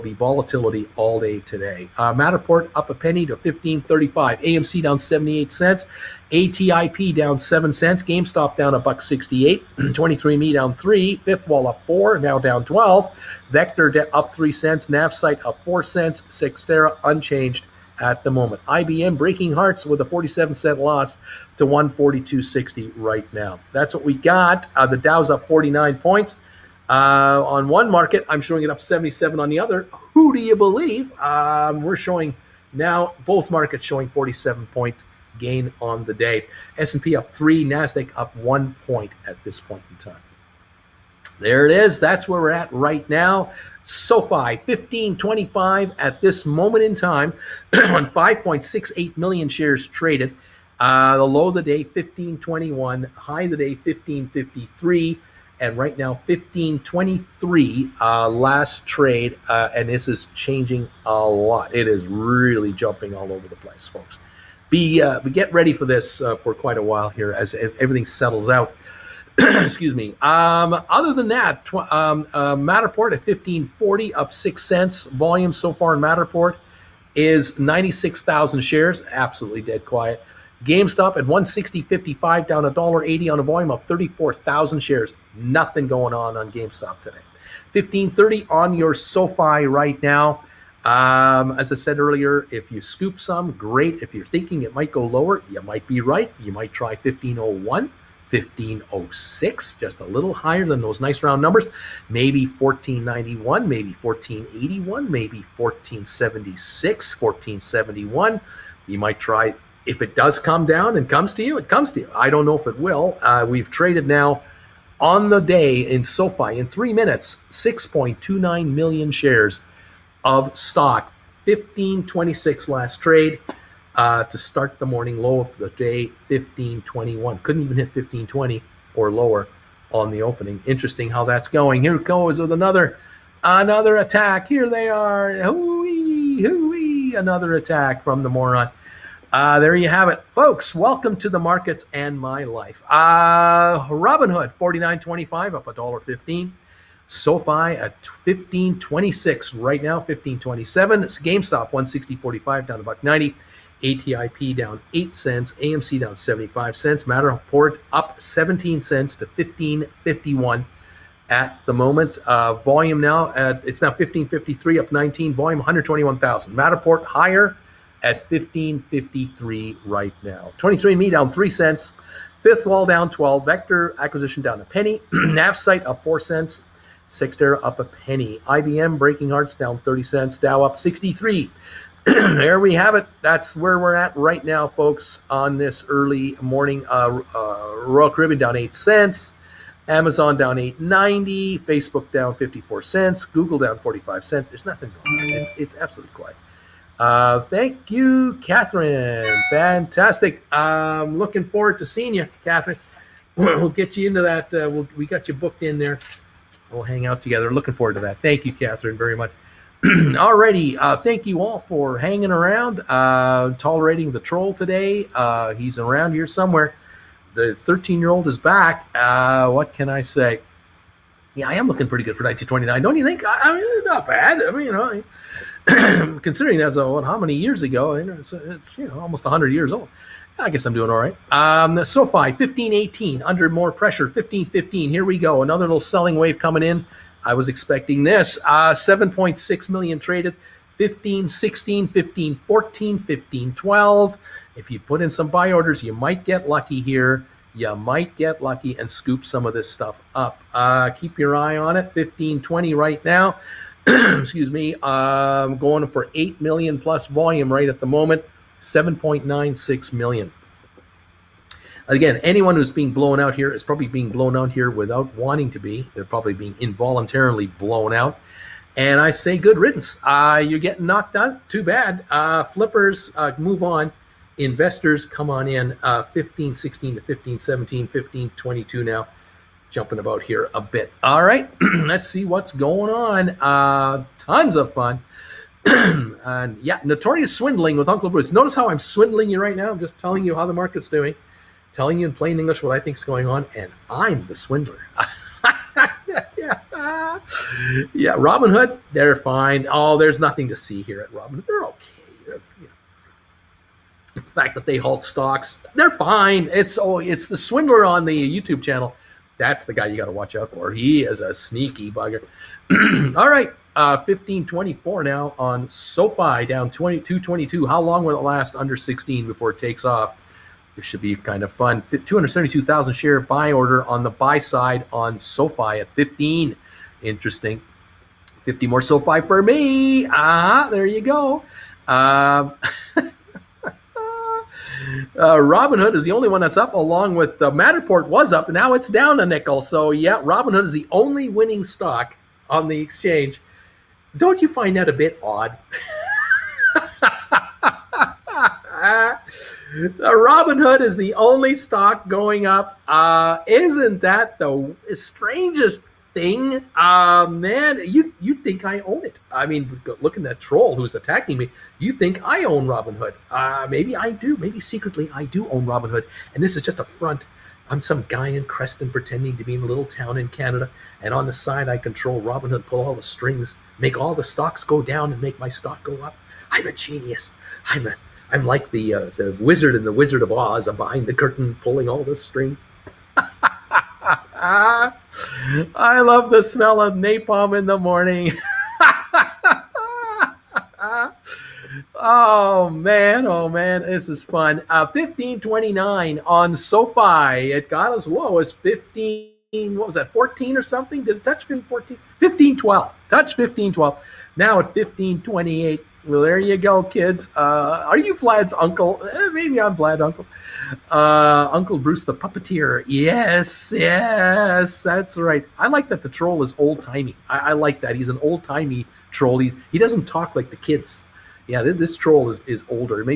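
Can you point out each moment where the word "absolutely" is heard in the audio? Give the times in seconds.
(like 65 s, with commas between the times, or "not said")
79 s, 195 s.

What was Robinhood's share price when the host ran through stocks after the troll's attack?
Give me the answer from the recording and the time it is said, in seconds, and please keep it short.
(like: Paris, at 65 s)
$49.25, at 144 s.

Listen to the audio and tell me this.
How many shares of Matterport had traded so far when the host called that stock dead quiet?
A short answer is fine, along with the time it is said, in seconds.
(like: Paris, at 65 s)
96,000, at 77 s.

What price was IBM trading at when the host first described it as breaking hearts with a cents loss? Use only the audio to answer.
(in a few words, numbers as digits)
$142.60.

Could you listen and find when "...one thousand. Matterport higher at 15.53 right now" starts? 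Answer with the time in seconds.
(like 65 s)
166 s.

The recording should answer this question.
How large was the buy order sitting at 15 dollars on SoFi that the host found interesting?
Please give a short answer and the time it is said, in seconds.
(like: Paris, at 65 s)
272,000 shares, at 321 s.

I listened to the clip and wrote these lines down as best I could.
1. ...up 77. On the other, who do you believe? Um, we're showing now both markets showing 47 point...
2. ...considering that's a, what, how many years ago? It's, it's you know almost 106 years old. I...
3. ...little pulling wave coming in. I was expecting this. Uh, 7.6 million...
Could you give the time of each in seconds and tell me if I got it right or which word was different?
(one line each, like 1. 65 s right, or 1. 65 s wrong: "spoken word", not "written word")
1. 28 s right
2. 226 s wrong: "100", not "106"
3. 235 s wrong: "selling", not "pulling".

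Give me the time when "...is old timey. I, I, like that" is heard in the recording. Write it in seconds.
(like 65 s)
416 s.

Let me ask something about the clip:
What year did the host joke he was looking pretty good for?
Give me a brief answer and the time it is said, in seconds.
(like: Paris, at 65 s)
1929, at 222 s.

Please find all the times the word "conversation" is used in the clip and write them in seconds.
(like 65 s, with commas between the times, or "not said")
not said.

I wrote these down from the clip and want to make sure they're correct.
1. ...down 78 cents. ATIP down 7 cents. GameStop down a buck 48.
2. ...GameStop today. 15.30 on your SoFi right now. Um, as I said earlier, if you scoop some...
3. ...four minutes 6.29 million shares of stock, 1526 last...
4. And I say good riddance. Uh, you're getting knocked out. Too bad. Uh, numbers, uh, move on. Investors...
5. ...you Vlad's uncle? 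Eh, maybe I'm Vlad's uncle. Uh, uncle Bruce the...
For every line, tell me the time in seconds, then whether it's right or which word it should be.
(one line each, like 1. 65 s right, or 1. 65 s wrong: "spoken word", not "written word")
1. 4 s wrong: "68", not "48"
2. 86 s right
3. 116 s wrong: "three", not "four"
4. 268 s wrong: "flippers", not "numbers"
5. 407 s right.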